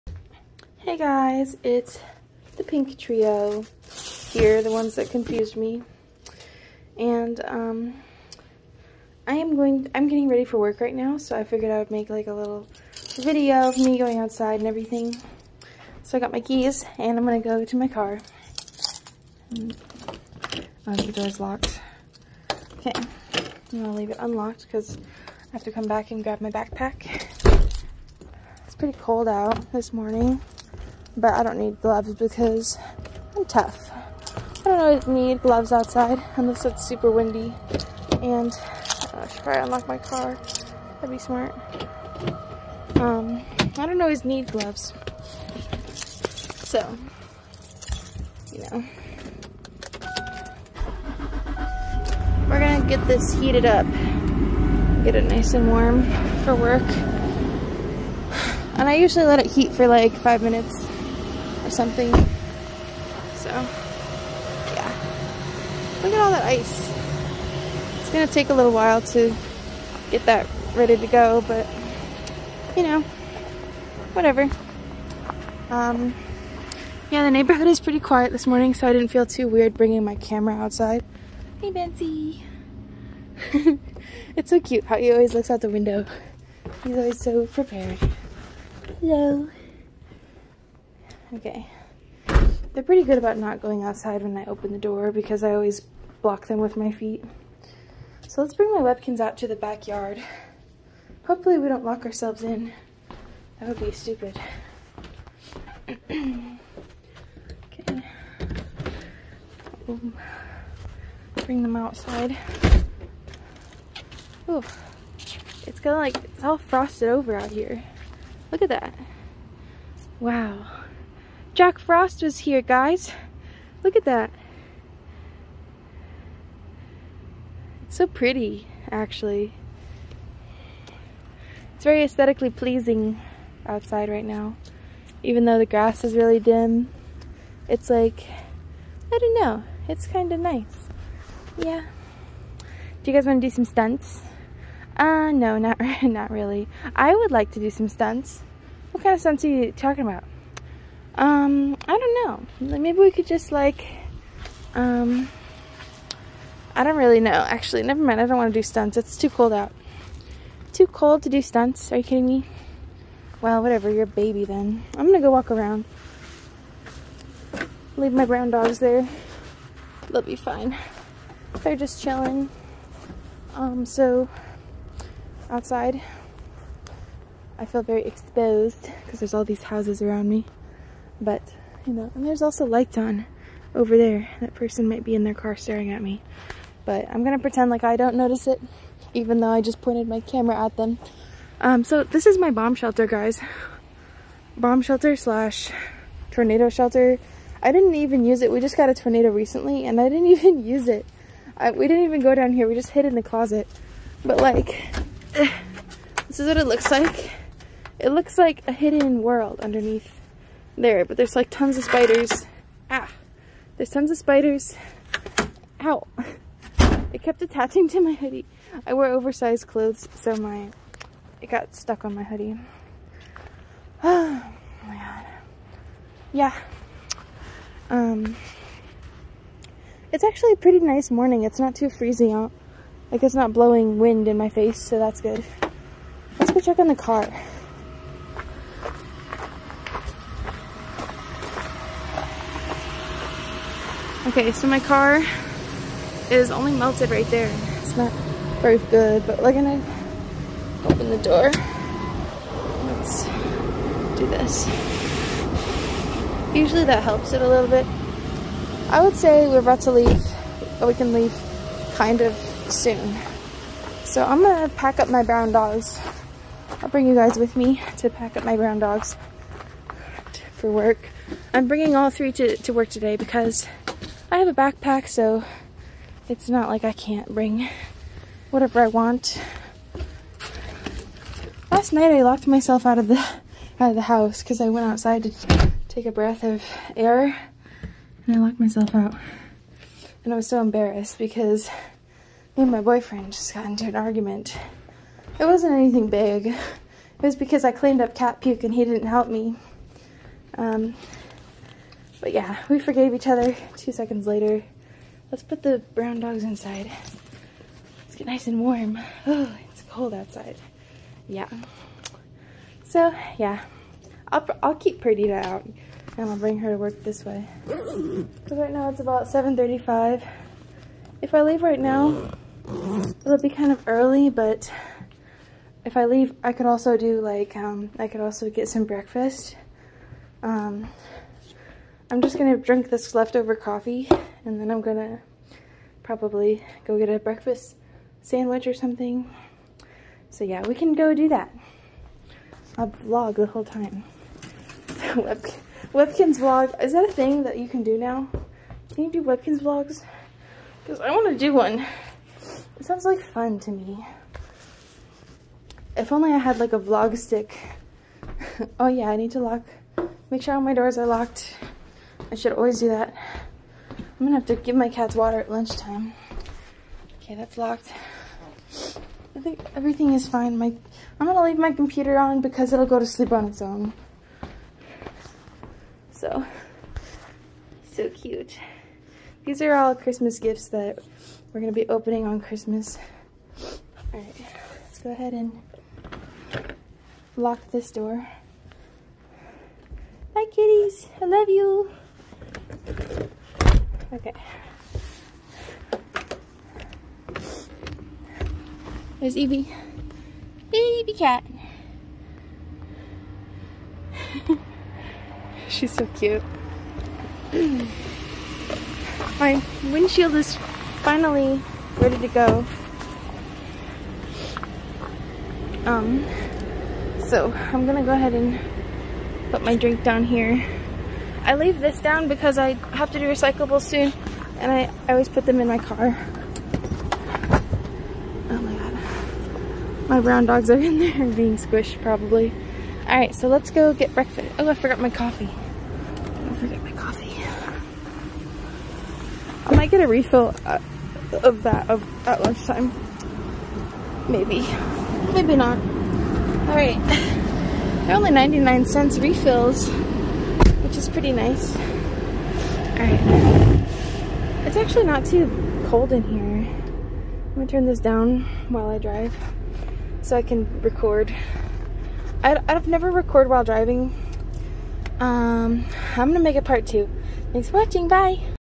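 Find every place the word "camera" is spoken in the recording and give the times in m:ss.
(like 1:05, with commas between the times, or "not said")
1:20, 3:10.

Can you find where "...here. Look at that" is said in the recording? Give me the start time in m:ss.
1:57.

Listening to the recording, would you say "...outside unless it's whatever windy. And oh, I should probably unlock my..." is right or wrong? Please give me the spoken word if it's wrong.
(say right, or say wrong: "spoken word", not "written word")
wrong: "super", not "whatever".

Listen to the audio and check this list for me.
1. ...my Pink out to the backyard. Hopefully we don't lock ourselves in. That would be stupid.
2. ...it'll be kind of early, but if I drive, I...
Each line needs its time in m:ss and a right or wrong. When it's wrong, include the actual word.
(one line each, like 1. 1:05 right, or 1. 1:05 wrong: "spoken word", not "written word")
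1. 1:38 wrong: "Webkins", not "Pink"
2. 5:23 wrong: "leave", not "drive".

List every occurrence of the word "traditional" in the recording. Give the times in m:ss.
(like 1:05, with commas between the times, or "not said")
not said.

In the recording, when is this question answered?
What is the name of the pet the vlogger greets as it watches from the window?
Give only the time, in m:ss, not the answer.
1:21.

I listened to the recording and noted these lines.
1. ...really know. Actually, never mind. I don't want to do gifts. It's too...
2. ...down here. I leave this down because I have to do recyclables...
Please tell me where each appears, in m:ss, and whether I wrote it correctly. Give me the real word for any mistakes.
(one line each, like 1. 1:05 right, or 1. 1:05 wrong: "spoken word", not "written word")
1. 2:36 wrong: "stunts", not "gifts"
2. 7:00 right.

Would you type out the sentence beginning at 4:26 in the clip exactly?
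I'll bring you guys with me to pack up my brown dogs for work.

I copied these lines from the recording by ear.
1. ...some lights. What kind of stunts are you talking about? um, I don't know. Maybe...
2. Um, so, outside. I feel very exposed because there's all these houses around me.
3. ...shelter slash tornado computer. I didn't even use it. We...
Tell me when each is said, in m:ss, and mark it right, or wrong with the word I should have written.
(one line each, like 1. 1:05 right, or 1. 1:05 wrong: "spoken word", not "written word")
1. 2:27 wrong: "stunts", not "lights"
2. 2:53 right
3. 3:14 wrong: "shelter", not "computer".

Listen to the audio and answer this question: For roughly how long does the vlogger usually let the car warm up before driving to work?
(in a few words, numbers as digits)
5 minutes.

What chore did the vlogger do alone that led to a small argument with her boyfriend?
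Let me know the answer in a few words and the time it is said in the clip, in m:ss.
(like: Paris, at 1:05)
Cleaned up cat puke, at 4:57.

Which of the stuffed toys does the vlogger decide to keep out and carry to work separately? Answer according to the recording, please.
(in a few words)
Perdita.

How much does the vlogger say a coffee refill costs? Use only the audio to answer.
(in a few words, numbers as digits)
99 cents.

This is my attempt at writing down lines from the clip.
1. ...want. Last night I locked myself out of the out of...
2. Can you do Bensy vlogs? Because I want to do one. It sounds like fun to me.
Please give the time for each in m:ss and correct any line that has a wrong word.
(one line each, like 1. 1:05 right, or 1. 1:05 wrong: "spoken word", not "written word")
1. 4:38 right
2. 5:48 wrong: "Webkinz", not "Bensy".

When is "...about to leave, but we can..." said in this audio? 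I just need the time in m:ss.
4:19.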